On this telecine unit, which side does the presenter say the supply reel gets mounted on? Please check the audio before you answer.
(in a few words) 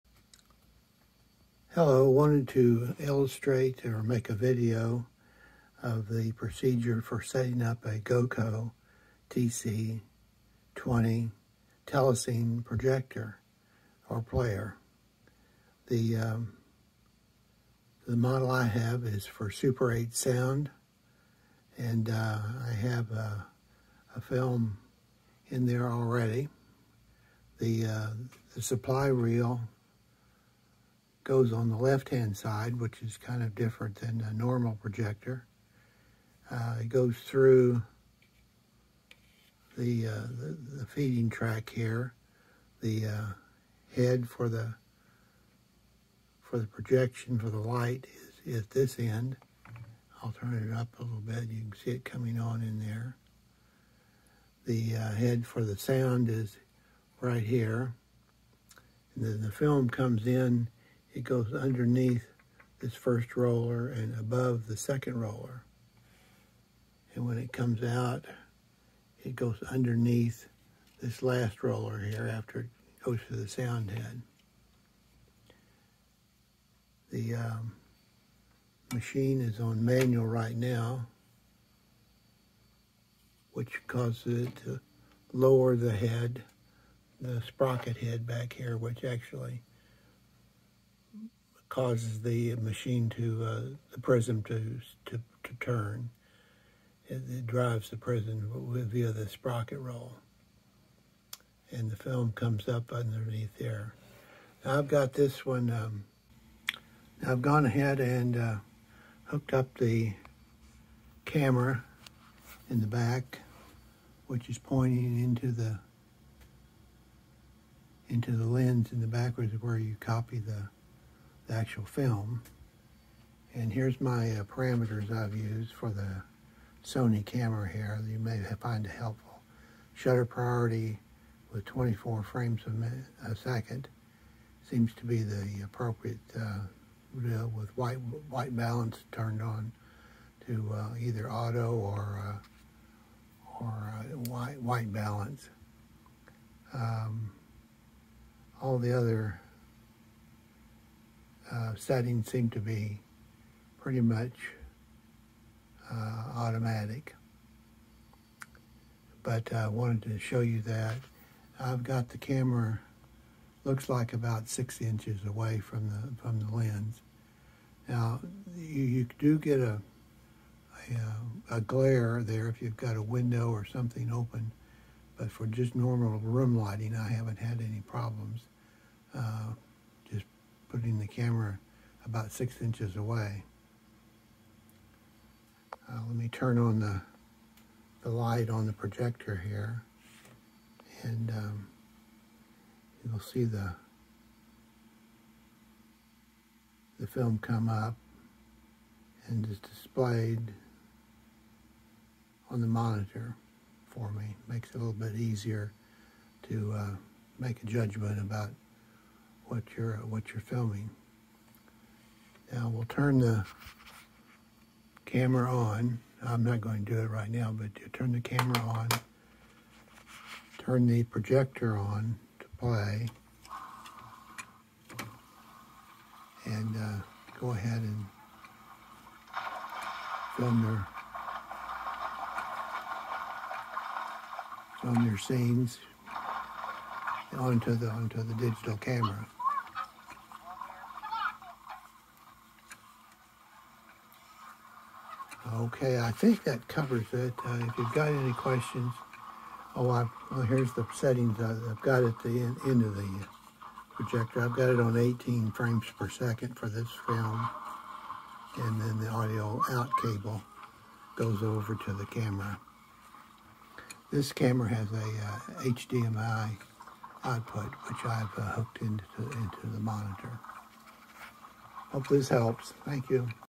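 Left-hand side.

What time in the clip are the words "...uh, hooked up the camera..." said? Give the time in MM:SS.
01:48.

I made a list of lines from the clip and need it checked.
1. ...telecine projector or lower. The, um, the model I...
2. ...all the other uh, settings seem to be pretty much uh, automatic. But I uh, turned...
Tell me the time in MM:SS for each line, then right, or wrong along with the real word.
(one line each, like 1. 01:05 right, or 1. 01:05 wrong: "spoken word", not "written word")
1. 00:11 wrong: "player", not "lower"
2. 02:28 wrong: "wanted", not "turned".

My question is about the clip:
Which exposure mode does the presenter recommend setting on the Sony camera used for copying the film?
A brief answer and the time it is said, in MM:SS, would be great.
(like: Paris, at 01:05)
Shutter priority, at 02:09.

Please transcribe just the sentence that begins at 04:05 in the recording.
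Okay, I think that covers it.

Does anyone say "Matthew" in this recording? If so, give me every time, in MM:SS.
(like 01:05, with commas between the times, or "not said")
not said.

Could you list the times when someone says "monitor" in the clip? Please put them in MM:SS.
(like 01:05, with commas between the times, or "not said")
03:22, 04:29.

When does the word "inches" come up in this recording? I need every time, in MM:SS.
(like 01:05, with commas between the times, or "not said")
02:44, 03:02.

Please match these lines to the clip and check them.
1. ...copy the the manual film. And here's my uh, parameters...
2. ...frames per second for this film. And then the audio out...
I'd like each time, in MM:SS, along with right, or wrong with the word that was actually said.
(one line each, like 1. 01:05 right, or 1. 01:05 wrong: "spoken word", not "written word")
1. 02:00 wrong: "actual", not "manual"
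2. 04:15 right.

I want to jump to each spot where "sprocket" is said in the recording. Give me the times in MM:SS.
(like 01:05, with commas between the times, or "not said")
01:27, 01:39.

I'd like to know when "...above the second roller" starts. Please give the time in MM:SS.
01:04.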